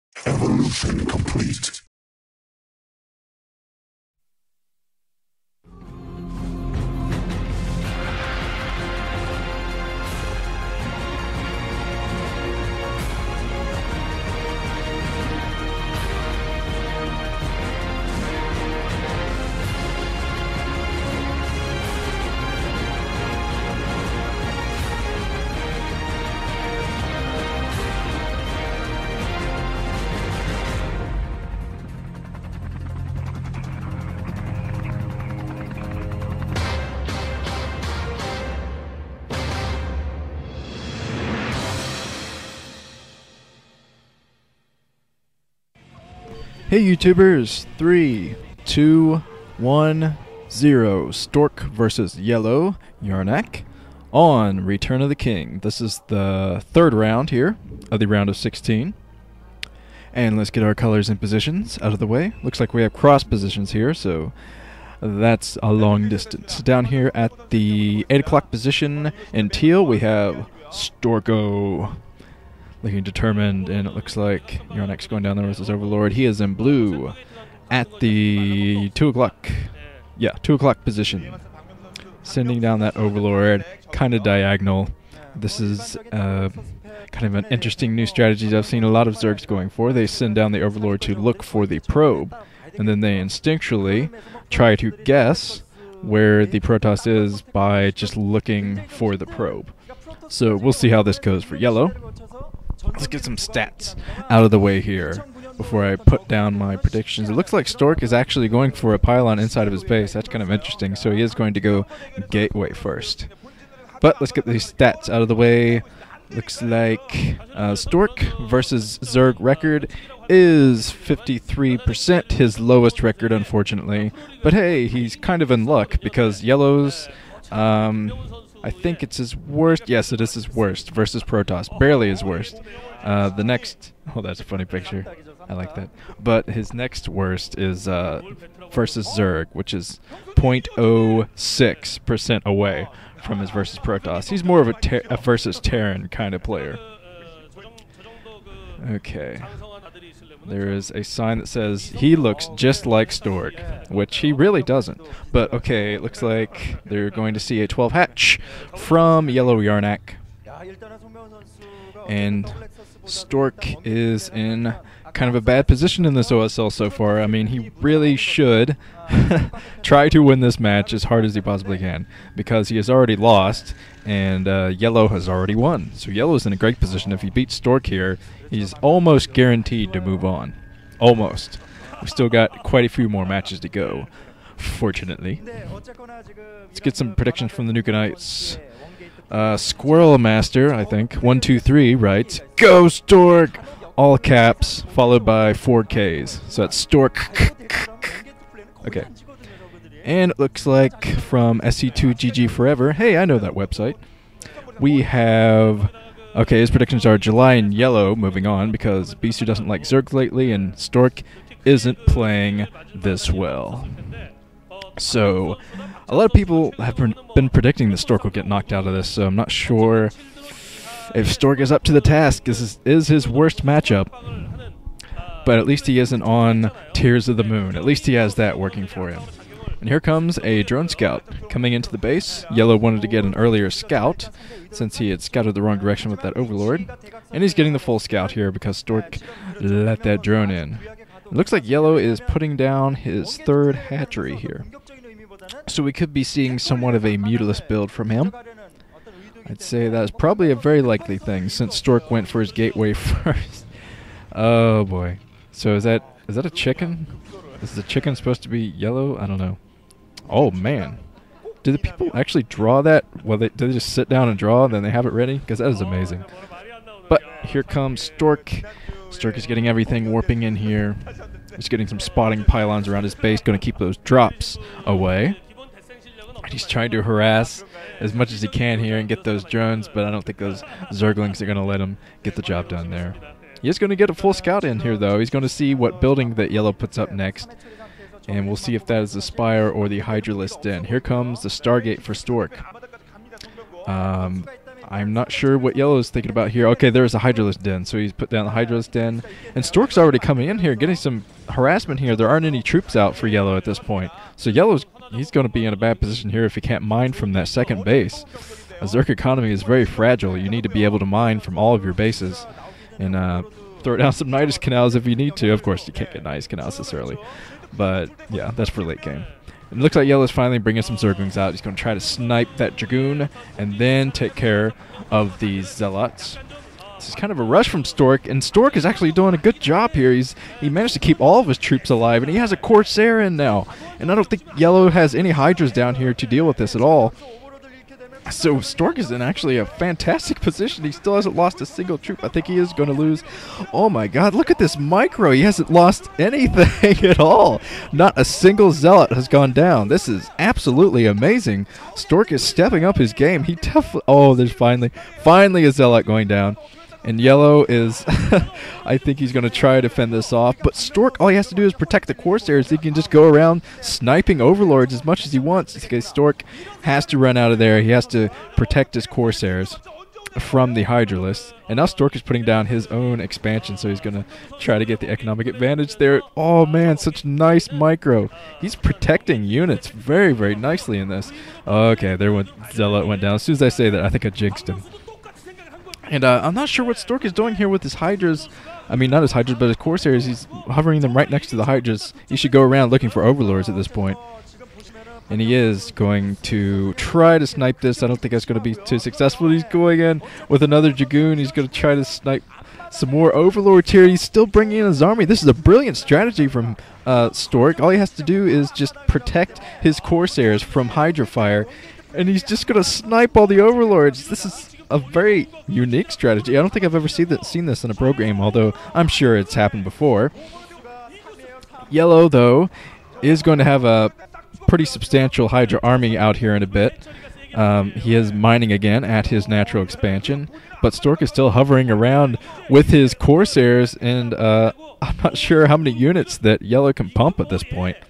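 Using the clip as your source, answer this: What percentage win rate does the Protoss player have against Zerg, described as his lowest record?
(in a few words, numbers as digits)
53%.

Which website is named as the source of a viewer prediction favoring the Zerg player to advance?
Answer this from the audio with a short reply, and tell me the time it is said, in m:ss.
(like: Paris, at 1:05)
SC2GG, at 3:21.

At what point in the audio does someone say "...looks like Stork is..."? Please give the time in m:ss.
1:47.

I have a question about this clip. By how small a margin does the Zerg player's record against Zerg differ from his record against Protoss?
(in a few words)
0.06%.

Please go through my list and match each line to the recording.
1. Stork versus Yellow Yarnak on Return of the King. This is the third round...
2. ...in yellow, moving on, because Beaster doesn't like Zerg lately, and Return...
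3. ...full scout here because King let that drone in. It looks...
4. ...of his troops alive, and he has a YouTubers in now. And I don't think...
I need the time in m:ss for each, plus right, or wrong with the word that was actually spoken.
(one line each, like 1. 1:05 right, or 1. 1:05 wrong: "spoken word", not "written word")
1. 0:51 right
2. 3:27 wrong: "Stork", not "Return"
3. 3:57 wrong: "Stork", not "King"
4. 5:31 wrong: "Corsair", not "YouTubers".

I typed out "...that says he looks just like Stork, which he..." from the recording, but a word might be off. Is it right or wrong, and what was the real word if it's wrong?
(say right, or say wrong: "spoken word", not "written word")
right.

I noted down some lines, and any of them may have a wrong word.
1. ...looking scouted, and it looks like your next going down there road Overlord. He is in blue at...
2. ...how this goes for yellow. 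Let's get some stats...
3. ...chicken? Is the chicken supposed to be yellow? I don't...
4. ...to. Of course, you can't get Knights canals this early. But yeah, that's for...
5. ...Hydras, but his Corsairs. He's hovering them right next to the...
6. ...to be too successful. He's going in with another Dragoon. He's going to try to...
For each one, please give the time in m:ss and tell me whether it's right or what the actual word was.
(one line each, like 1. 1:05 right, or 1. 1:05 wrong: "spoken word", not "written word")
1. 1:12 wrong: "determined", not "scouted"
2. 1:40 right
3. 4:16 right
4. 5:15 wrong: "Nydus", not "Knights"
5. 6:29 right
6. 6:38 right.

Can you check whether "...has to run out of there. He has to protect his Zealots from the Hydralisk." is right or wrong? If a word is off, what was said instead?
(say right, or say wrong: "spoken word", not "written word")
wrong: "Corsairs", not "Zealots".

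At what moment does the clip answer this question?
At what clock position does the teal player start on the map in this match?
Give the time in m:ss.
1:08.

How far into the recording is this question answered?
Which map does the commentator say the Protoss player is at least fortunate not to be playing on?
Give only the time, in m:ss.
3:46.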